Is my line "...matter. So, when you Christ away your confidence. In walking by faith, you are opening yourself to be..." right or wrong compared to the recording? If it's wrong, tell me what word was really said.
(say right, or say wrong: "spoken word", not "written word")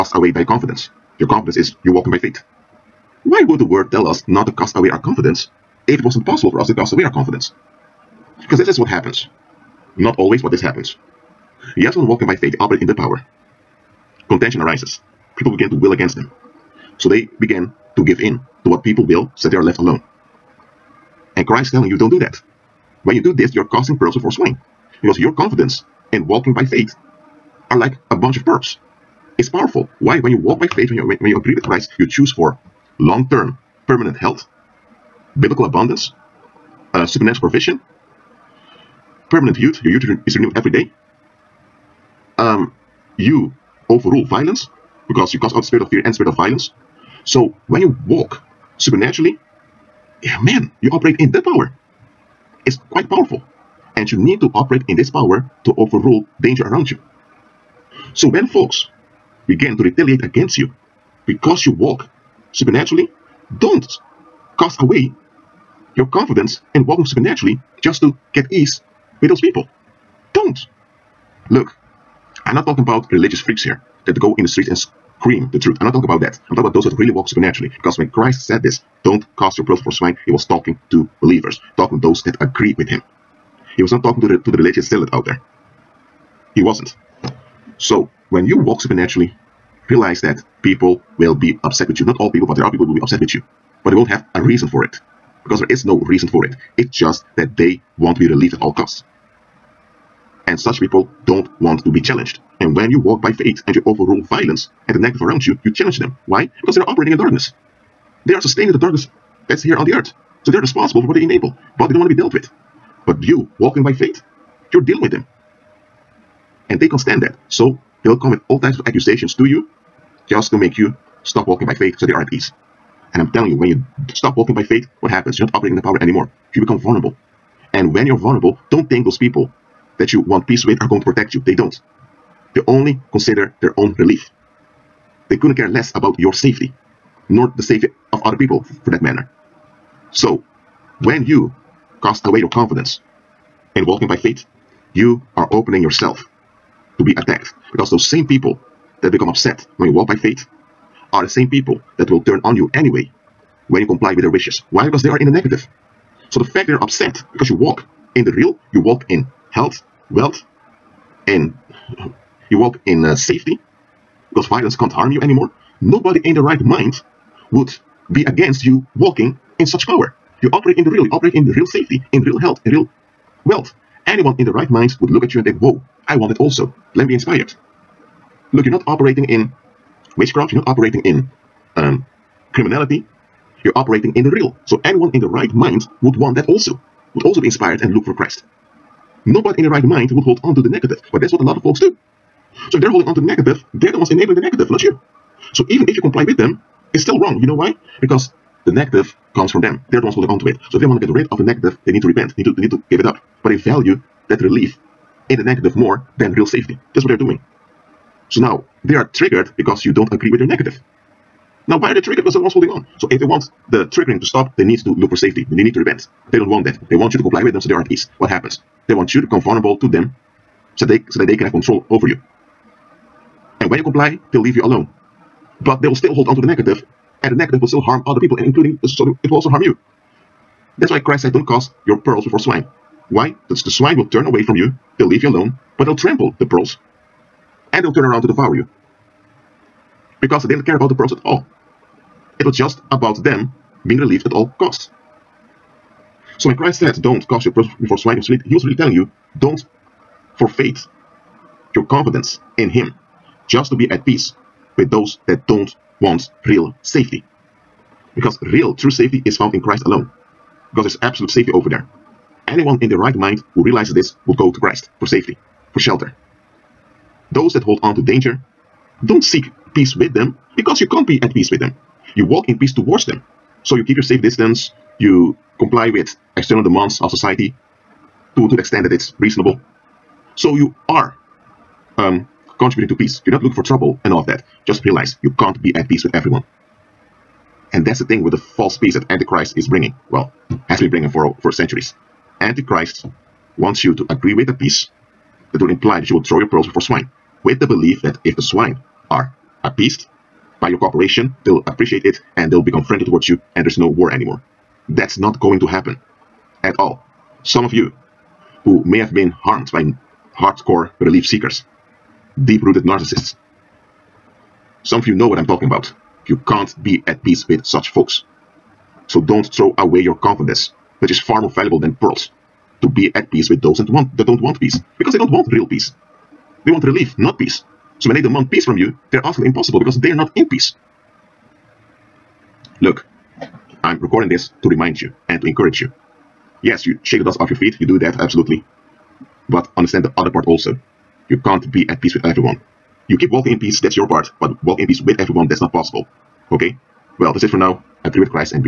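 wrong: "Cast", not "Christ".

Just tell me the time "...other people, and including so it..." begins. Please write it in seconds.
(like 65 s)
228 s.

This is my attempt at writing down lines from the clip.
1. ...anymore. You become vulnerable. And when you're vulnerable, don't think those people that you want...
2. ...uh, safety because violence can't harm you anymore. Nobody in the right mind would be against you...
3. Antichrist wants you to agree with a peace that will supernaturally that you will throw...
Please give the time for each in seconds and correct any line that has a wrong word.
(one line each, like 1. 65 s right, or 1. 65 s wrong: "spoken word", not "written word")
1. 126 s right
2. 163 s right
3. 292 s wrong: "imply", not "supernaturally".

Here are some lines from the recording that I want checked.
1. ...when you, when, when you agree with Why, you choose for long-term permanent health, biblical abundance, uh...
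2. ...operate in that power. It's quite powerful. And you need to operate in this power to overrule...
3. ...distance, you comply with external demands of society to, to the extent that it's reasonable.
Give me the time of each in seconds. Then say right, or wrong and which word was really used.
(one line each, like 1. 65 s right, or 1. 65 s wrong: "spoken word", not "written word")
1. 30 s wrong: "Christ", not "Why"
2. 50 s right
3. 274 s right.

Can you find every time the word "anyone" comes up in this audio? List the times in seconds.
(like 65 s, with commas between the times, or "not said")
174 s, 184 s, 262 s.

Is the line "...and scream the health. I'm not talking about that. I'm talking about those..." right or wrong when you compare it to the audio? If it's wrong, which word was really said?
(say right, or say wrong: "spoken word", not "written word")
wrong: "truth", not "health".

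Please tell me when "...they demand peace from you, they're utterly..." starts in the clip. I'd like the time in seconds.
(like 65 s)
328 s.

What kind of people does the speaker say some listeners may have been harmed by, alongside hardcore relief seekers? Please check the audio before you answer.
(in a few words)
Deep-rooted narcissists.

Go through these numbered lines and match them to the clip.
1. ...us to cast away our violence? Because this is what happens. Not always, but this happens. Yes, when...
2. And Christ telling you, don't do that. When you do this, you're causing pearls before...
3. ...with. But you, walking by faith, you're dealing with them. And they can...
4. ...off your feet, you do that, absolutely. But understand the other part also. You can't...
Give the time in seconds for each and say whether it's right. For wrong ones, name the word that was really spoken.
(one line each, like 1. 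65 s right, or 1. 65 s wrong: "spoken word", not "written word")
1. 6 s wrong: "confidence", not "violence"
2. 21 s right
3. 112 s right
4. 337 s right.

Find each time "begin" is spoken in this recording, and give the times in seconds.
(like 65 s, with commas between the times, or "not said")
15 s, 59 s.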